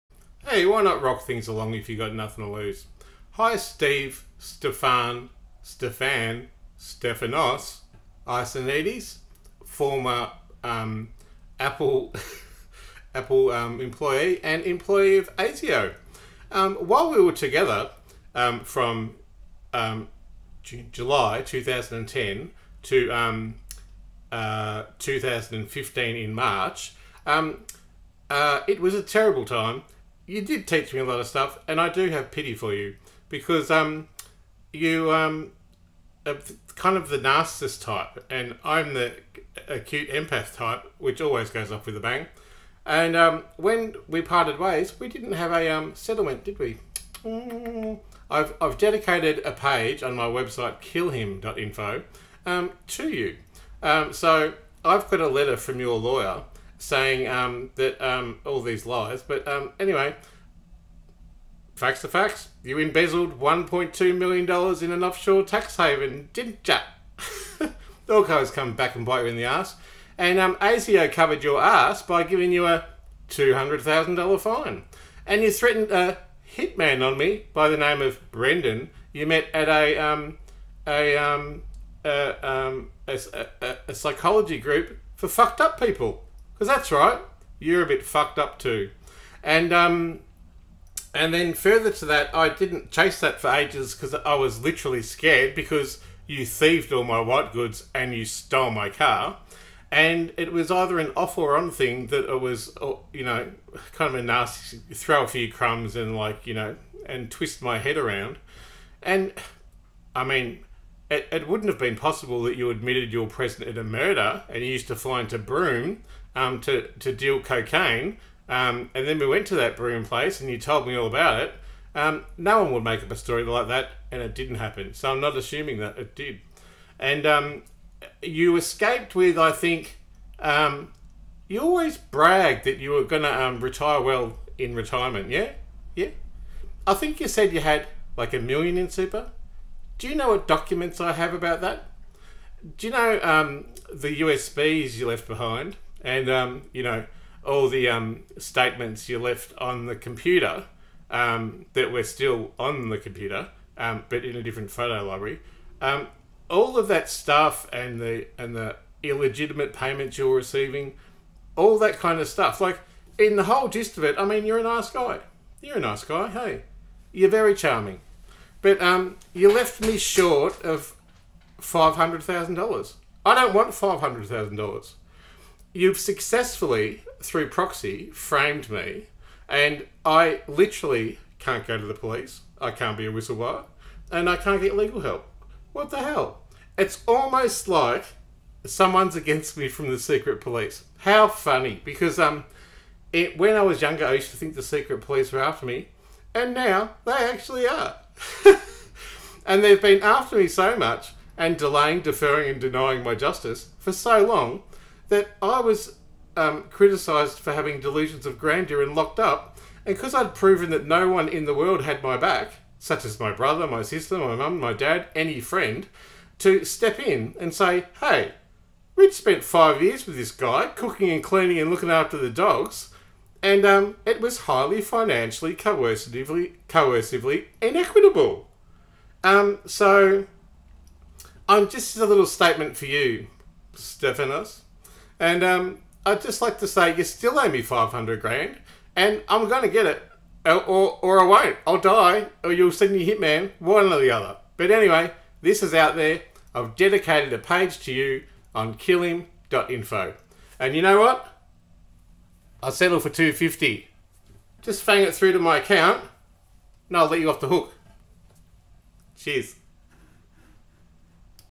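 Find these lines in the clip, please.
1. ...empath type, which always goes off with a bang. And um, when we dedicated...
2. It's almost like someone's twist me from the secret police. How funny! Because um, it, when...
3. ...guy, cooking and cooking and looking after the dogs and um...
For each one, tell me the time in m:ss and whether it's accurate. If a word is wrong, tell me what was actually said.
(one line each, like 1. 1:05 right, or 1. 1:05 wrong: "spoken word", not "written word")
1. 0:40 wrong: "parted", not "dedicated"
2. 3:06 wrong: "against", not "twist"
3. 3:40 wrong: "cleaning", not "cooking".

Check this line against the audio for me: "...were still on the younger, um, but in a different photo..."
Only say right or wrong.
wrong.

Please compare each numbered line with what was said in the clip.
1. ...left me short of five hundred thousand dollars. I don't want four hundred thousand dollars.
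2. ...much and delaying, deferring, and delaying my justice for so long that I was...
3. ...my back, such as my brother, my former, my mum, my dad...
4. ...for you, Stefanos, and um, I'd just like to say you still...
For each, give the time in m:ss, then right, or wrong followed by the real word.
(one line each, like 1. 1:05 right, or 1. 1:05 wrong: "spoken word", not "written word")
1. 2:49 wrong: "five", not "four"
2. 3:20 wrong: "denying", not "delaying"
3. 3:32 wrong: "sister", not "former"
4. 3:52 right.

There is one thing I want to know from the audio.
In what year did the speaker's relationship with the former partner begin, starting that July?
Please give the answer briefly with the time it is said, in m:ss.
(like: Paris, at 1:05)
2010, at 0:21.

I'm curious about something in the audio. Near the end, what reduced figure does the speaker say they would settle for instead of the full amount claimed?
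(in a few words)
250.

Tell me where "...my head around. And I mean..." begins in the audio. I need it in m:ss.
1:47.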